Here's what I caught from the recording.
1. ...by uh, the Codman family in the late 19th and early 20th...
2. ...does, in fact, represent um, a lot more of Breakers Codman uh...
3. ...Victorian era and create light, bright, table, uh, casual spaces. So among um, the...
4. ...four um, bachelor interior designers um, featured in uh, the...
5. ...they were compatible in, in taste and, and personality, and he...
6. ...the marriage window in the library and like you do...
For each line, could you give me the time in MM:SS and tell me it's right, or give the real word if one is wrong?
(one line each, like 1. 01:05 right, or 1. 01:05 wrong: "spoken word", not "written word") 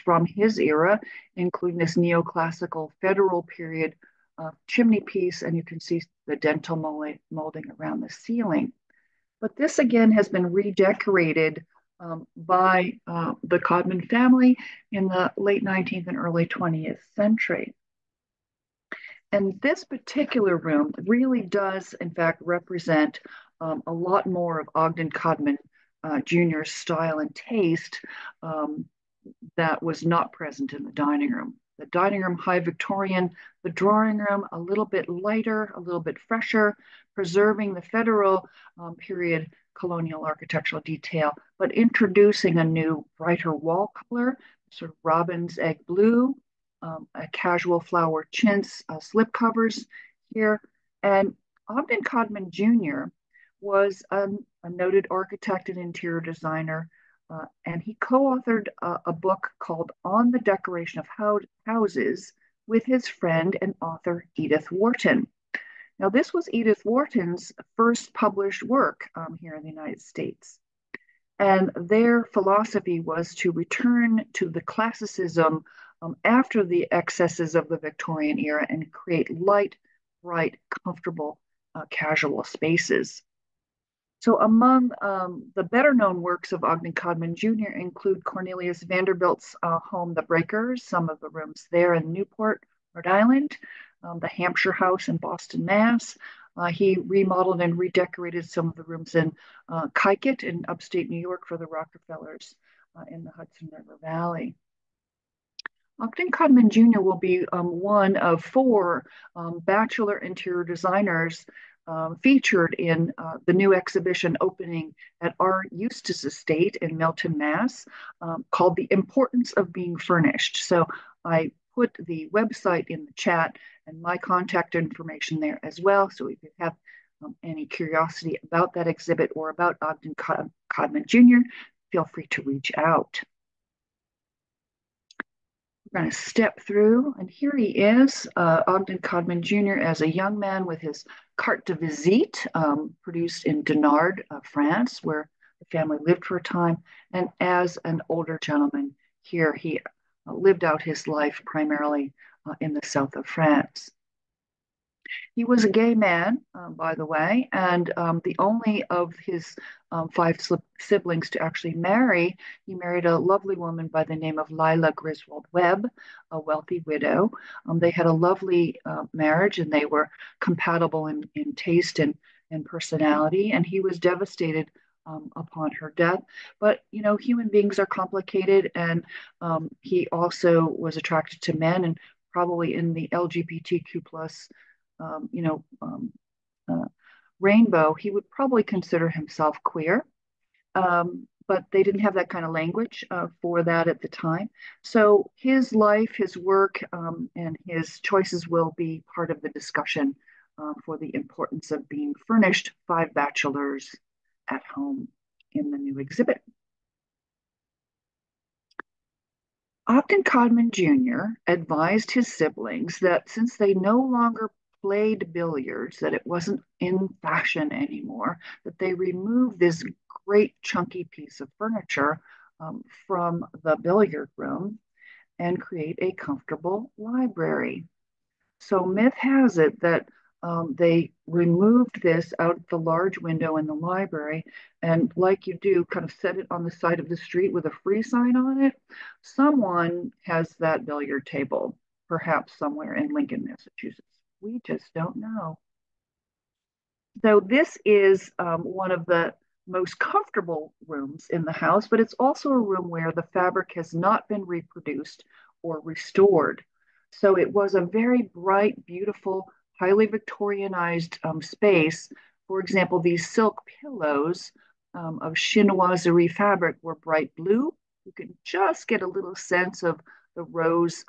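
1. 00:12 right
2. 00:21 wrong: "Ogden", not "Breakers"
3. 01:17 wrong: "comfortable", not "table"
4. 01:48 right
5. 02:49 right
6. 03:52 wrong: "large", not "marriage".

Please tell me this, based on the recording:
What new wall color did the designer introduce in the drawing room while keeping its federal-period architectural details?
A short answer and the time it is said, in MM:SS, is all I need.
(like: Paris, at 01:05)
Robin's egg blue, at 00:45.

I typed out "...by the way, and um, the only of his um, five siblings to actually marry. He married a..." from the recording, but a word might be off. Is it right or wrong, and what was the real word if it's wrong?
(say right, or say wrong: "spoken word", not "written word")
right.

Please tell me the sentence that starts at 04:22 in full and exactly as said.
For example, these silk pillows um, of chinoiserie fabric were bright blue.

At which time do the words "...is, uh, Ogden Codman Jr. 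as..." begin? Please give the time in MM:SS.
02:17.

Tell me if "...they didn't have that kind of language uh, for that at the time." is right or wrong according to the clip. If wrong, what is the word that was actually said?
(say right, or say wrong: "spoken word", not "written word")
right.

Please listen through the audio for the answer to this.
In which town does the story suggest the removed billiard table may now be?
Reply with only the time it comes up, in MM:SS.
04:03.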